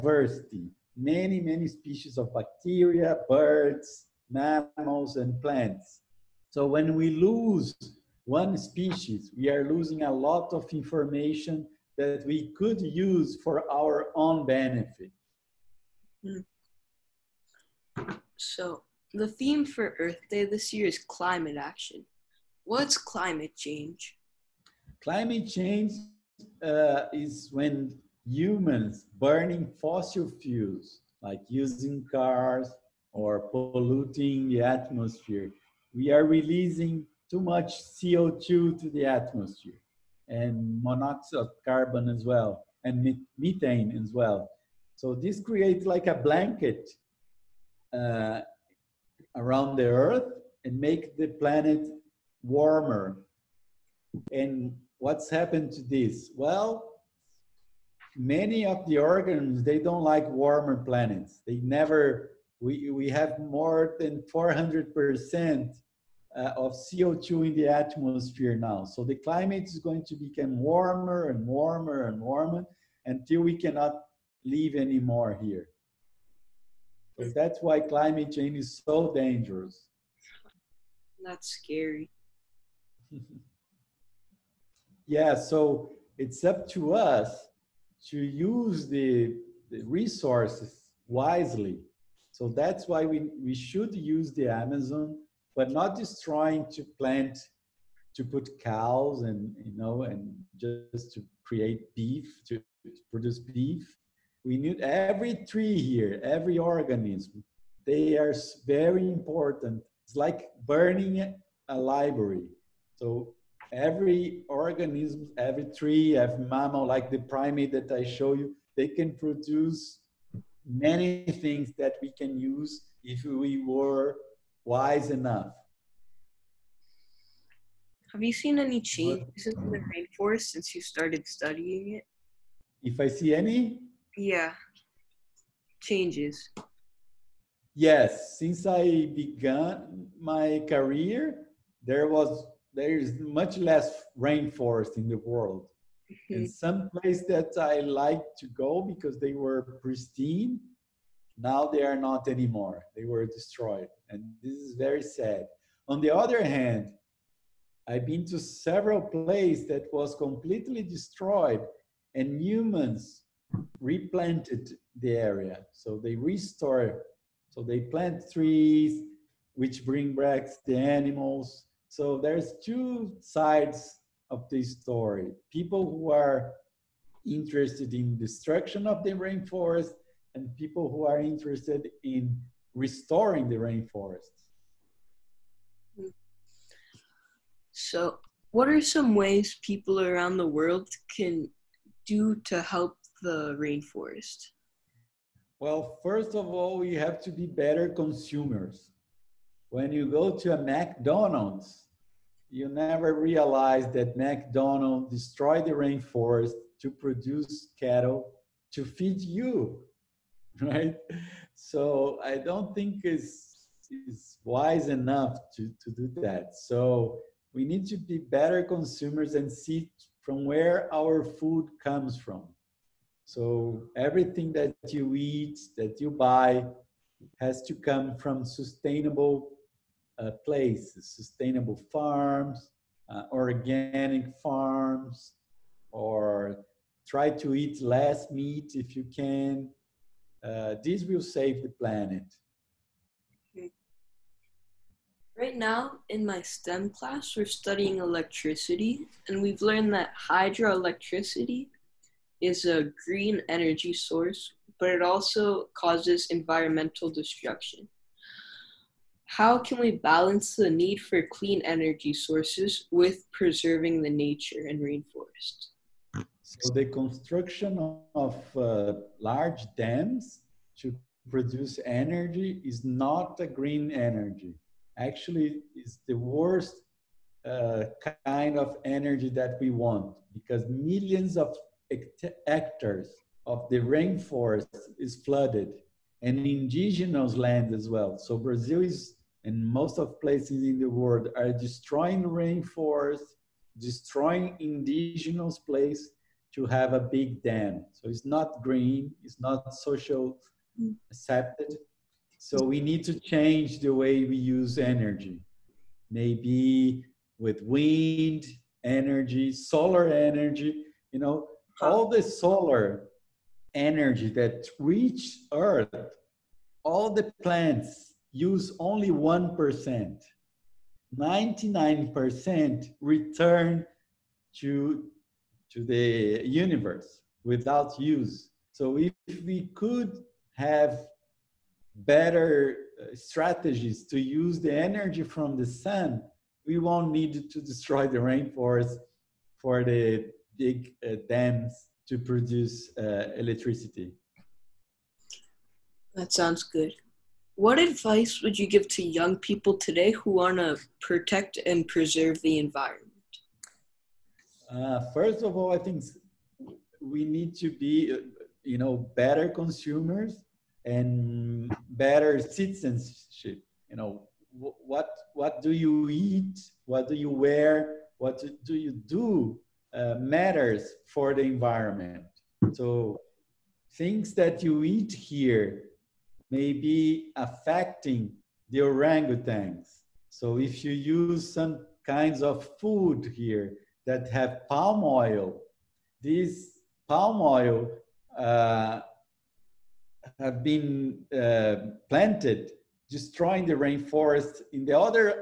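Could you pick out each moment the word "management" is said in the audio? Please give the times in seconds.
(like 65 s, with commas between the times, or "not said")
not said.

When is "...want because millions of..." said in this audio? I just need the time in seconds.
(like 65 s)
279 s.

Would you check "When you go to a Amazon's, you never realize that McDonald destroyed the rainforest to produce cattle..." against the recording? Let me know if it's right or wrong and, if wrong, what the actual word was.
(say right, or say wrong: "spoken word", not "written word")
wrong: "McDonald", not "Amazon".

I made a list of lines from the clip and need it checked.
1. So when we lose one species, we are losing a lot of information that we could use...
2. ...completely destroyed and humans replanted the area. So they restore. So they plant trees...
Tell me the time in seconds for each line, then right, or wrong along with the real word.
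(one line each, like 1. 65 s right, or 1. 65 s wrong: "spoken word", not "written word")
1. 6 s right
2. 160 s right.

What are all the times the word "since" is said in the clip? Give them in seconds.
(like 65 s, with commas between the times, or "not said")
130 s, 138 s.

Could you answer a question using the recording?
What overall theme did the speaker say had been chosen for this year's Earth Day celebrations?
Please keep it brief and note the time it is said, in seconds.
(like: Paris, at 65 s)
climate action, at 20 s.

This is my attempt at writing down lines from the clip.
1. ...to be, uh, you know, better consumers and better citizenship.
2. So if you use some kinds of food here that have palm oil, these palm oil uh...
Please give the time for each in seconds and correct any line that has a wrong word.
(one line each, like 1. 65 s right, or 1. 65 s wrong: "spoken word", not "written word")
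1. 357 s right
2. 380 s right.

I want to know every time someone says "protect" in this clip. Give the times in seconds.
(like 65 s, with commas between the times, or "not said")
351 s.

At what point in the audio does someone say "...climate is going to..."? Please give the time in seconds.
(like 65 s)
69 s.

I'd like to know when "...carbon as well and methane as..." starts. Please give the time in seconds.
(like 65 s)
41 s.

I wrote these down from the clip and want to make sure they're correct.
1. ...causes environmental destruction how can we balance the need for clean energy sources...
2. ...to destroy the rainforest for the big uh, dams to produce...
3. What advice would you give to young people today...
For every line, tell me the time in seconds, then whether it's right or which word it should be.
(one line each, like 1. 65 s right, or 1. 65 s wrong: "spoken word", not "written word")
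1. 255 s right
2. 337 s right
3. 347 s right.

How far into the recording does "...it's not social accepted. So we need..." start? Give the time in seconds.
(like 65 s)
299 s.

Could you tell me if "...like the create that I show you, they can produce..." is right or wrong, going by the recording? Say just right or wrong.
wrong.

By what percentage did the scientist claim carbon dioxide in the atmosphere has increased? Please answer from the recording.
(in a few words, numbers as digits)
400%.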